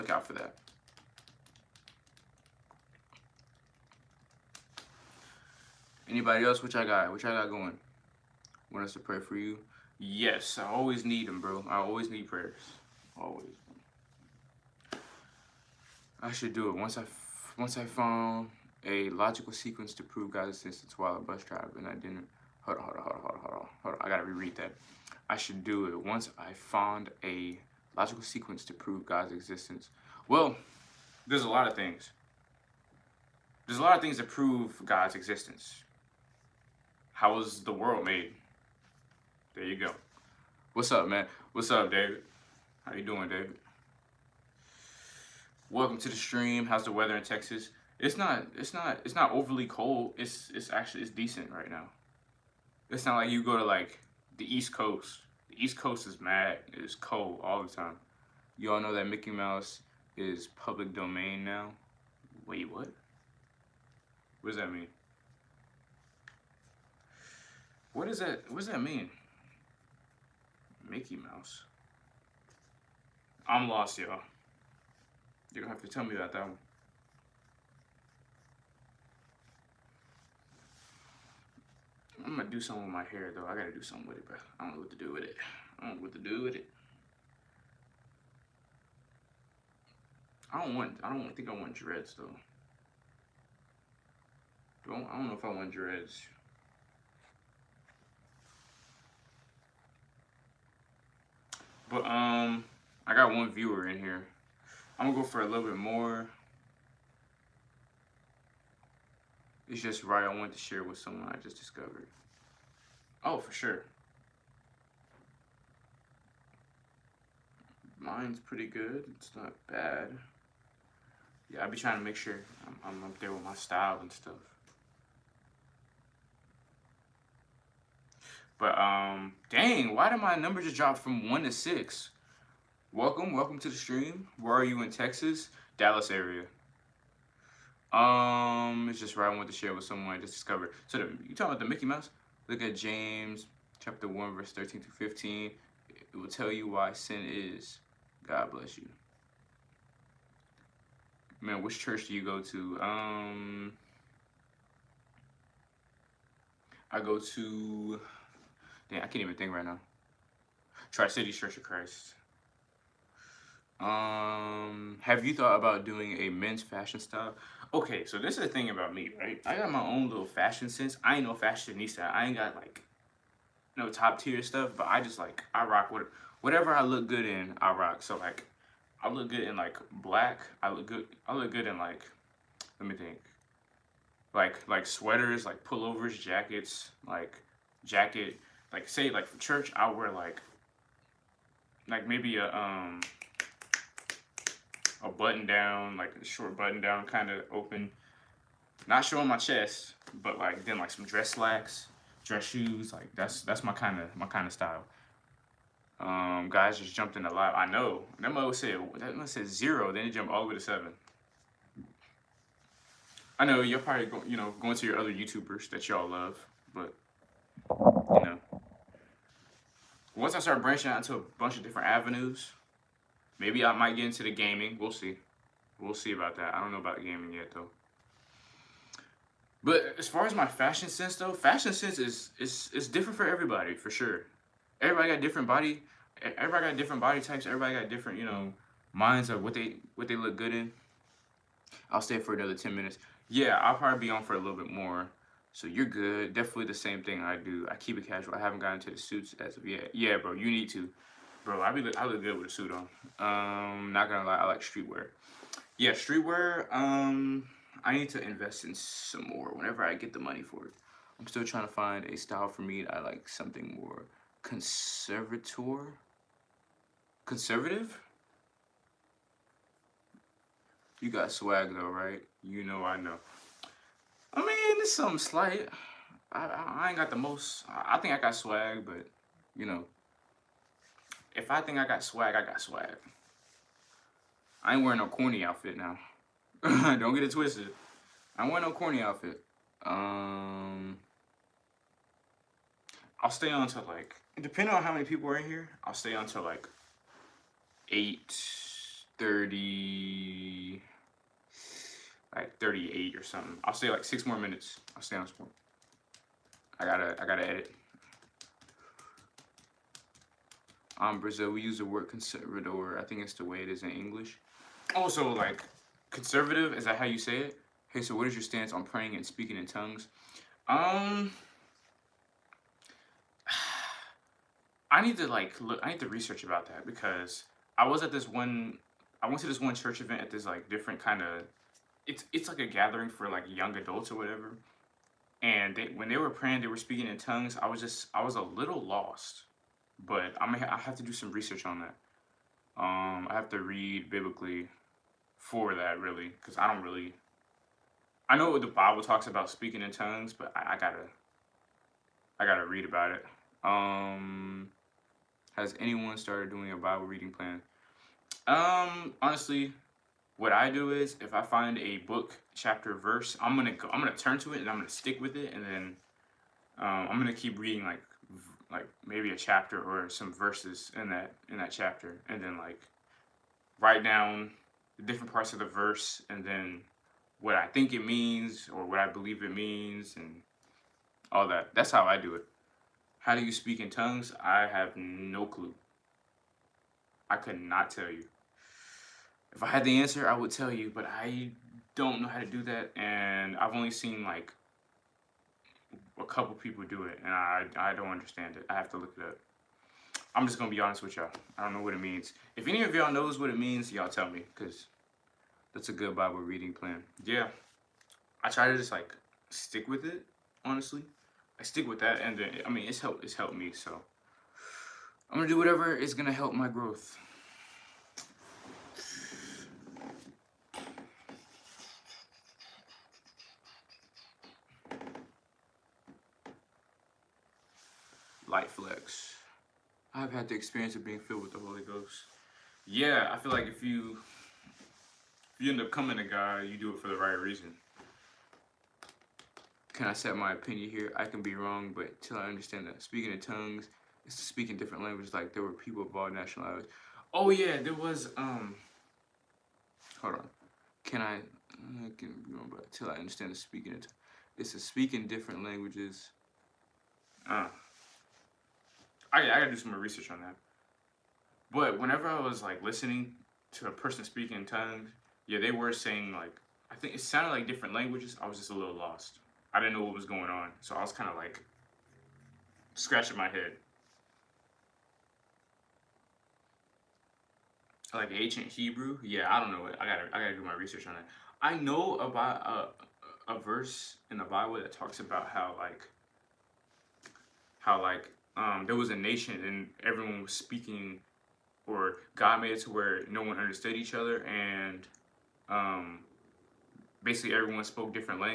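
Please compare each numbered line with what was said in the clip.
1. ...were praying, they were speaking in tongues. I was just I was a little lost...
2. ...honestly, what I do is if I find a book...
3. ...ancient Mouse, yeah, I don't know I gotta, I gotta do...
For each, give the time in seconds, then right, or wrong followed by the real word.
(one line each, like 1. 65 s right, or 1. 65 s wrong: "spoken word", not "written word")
1. 336 s right
2. 359 s right
3. 478 s wrong: "Hebrew", not "Mouse".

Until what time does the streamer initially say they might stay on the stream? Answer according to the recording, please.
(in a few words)
8:30.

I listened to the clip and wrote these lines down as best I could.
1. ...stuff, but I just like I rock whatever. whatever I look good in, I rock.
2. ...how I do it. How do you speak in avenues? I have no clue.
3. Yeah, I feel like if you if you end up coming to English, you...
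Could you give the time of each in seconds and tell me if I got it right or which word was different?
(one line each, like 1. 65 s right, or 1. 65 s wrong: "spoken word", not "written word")
1. 174 s right
2. 381 s wrong: "tongues", not "avenues"
3. 432 s wrong: "God", not "English".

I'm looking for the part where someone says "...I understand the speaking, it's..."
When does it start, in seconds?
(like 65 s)
453 s.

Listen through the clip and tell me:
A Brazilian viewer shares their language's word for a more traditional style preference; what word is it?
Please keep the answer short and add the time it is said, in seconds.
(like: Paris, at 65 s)
conservador, at 312 s.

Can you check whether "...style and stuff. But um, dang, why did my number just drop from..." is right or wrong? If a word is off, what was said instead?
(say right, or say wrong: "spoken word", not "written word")
right.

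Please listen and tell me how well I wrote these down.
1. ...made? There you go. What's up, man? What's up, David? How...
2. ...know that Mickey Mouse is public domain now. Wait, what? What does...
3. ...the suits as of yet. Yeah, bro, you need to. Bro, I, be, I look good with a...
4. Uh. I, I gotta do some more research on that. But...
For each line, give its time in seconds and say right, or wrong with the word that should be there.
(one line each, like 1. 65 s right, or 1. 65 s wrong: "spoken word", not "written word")
1. 38 s right
2. 58 s right
3. 248 s right
4. 457 s right.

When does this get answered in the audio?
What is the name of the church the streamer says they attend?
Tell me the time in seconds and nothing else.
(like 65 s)
160 s.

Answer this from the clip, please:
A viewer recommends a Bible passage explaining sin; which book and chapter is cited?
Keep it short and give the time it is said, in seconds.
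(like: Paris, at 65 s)
James chapter 1, at 142 s.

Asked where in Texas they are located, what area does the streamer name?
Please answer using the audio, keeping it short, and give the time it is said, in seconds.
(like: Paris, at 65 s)
Dallas area, at 135 s.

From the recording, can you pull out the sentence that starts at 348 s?
I know what the Bible talks about speaking in tongues, but I, I gotta I gotta read about it.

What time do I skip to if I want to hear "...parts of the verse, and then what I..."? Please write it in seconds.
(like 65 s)
375 s.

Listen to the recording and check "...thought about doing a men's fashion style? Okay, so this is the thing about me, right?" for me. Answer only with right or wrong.
right.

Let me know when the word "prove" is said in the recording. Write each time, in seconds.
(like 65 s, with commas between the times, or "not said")
20 s, 28 s, 34 s.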